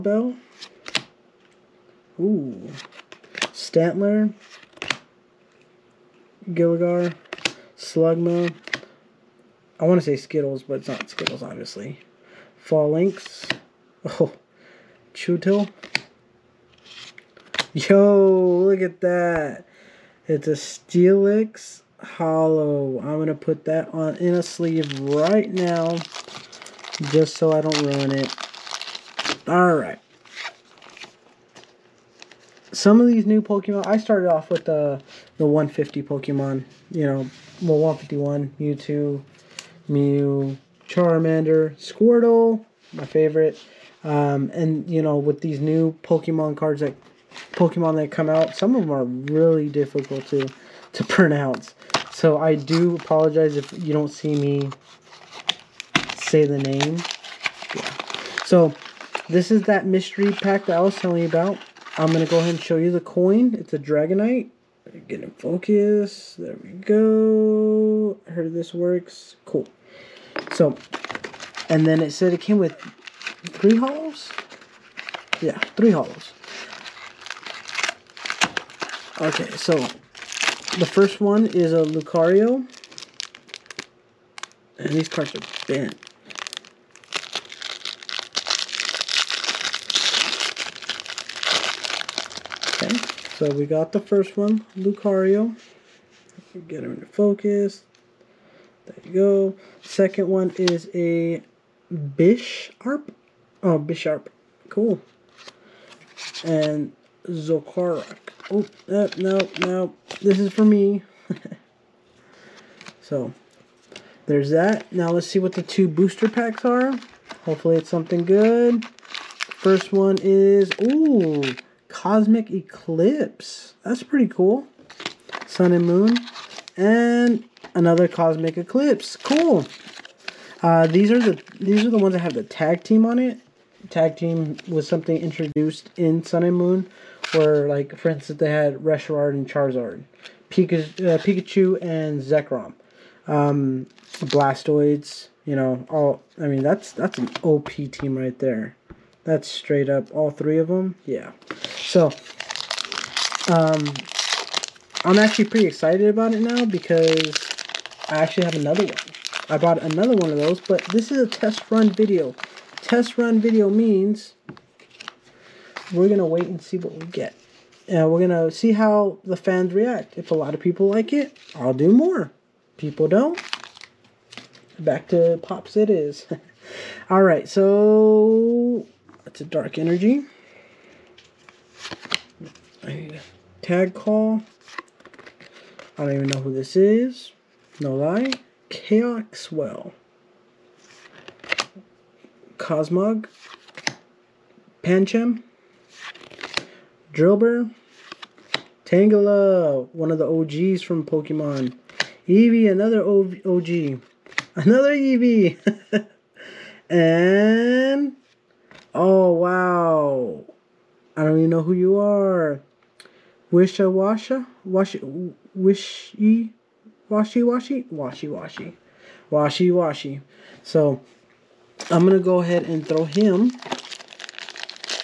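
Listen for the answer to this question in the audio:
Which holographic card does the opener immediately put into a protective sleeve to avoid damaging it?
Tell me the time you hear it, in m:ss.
0:20.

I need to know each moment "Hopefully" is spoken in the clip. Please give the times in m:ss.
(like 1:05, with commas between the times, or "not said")
1:57.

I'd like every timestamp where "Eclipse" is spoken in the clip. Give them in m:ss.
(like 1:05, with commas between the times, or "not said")
2:02, 2:08.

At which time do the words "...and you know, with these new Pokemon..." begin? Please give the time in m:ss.
0:44.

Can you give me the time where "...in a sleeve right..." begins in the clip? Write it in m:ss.
0:24.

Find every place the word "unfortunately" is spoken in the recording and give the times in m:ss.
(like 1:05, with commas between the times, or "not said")
not said.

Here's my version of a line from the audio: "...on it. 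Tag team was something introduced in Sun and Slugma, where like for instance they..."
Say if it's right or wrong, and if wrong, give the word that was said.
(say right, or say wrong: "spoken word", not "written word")
wrong: "Moon", not "Slugma".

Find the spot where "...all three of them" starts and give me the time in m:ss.
2:30.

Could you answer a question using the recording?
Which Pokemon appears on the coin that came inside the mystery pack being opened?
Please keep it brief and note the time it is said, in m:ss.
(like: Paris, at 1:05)
Dragonite, at 1:03.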